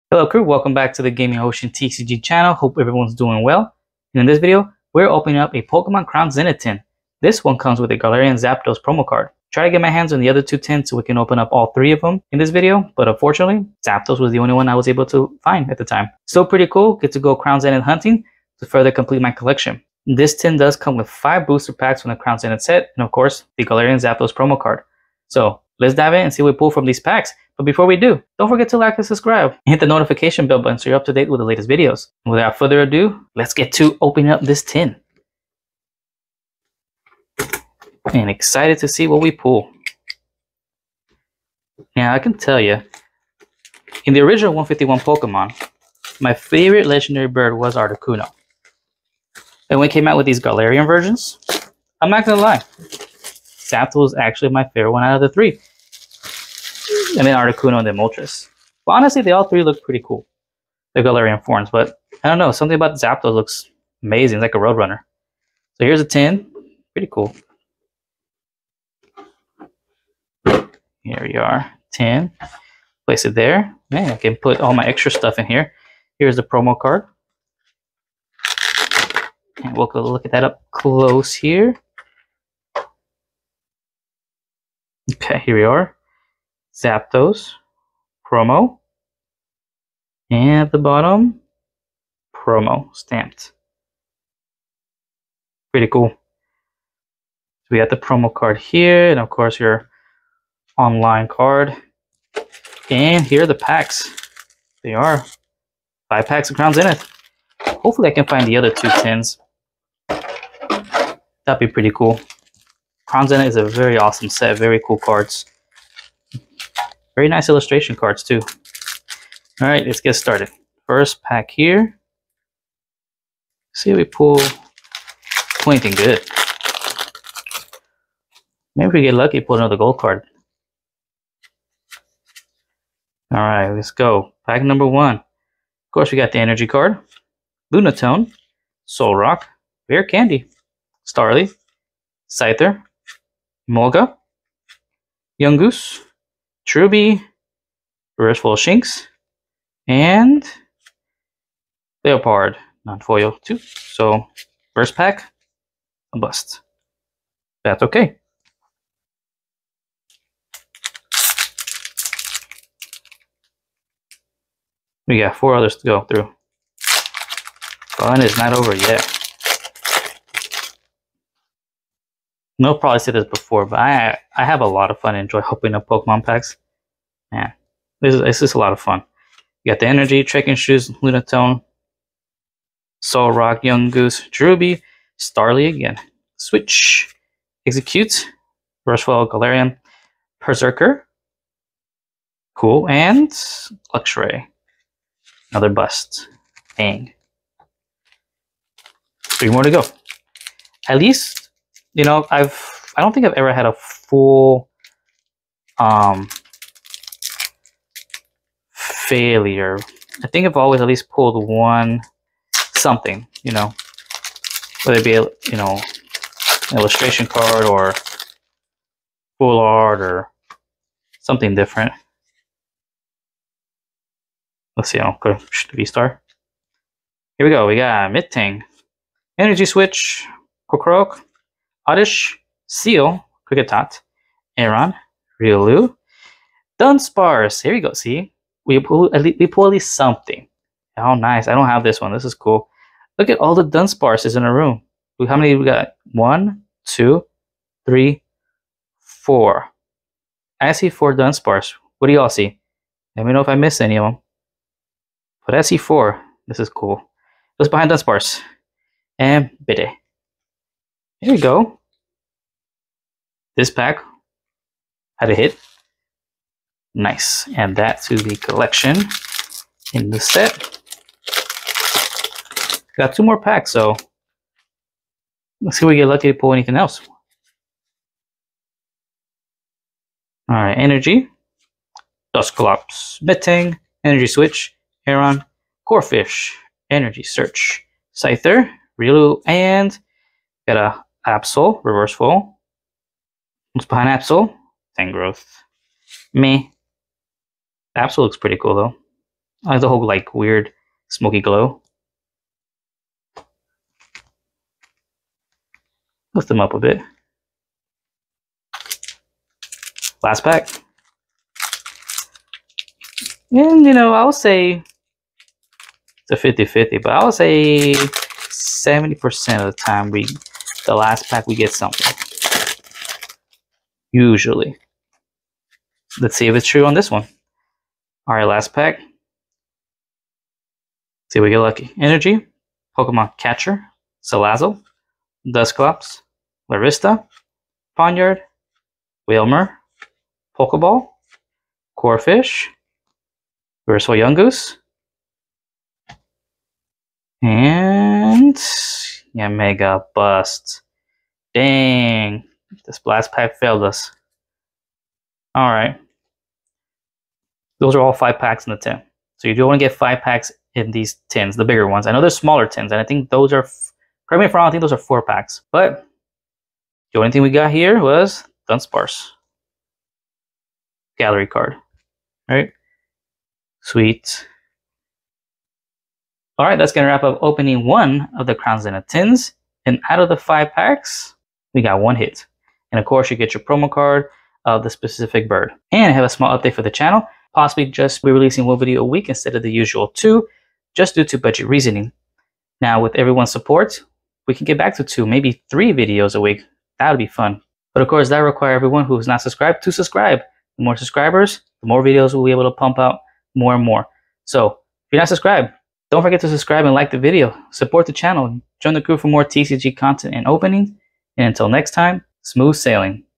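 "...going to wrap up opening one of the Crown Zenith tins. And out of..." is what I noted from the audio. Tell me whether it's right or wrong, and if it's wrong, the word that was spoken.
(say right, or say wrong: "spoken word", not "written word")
right.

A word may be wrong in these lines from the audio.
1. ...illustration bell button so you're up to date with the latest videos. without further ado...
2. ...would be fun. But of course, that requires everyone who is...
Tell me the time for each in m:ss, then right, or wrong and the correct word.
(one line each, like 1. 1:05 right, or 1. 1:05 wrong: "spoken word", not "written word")
1. 0:29 wrong: "notification", not "illustration"
2. 6:37 right.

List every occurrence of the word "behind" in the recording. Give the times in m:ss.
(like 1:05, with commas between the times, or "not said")
4:17, 4:53.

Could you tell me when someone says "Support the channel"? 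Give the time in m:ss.
6:47.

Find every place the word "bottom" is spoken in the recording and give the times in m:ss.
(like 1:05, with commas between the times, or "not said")
1:30.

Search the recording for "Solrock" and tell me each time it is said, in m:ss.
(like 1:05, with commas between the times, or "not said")
2:18, 3:03.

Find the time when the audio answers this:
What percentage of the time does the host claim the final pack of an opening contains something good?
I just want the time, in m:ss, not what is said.
5:17.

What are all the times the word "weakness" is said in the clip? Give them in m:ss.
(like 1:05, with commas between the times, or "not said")
not said.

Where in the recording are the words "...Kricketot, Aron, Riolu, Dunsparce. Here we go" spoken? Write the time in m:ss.
3:53.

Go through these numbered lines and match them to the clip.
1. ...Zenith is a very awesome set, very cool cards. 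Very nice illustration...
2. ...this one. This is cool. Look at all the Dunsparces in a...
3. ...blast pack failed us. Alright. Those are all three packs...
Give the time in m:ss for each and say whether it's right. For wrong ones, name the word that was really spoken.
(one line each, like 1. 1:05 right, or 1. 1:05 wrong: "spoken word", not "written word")
1. 1:53 right
2. 4:01 right
3. 5:52 wrong: "five", not "three".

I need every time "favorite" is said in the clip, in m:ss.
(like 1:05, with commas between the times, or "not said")
0:46, 0:54.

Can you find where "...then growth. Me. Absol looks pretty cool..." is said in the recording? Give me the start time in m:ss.
4:54.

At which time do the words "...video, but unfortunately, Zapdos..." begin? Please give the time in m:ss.
0:12.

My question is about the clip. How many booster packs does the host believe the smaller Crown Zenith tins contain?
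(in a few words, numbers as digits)
4.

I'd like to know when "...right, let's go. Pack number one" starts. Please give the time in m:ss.
2:13.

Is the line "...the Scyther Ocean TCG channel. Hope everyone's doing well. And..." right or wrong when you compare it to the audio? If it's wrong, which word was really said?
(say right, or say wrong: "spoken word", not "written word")
wrong: "Gaming", not "Scyther".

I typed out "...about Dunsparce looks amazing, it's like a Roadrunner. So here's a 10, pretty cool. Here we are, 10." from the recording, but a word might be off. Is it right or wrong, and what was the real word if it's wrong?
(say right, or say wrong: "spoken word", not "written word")
wrong: "Zapdos", not "Dunsparce".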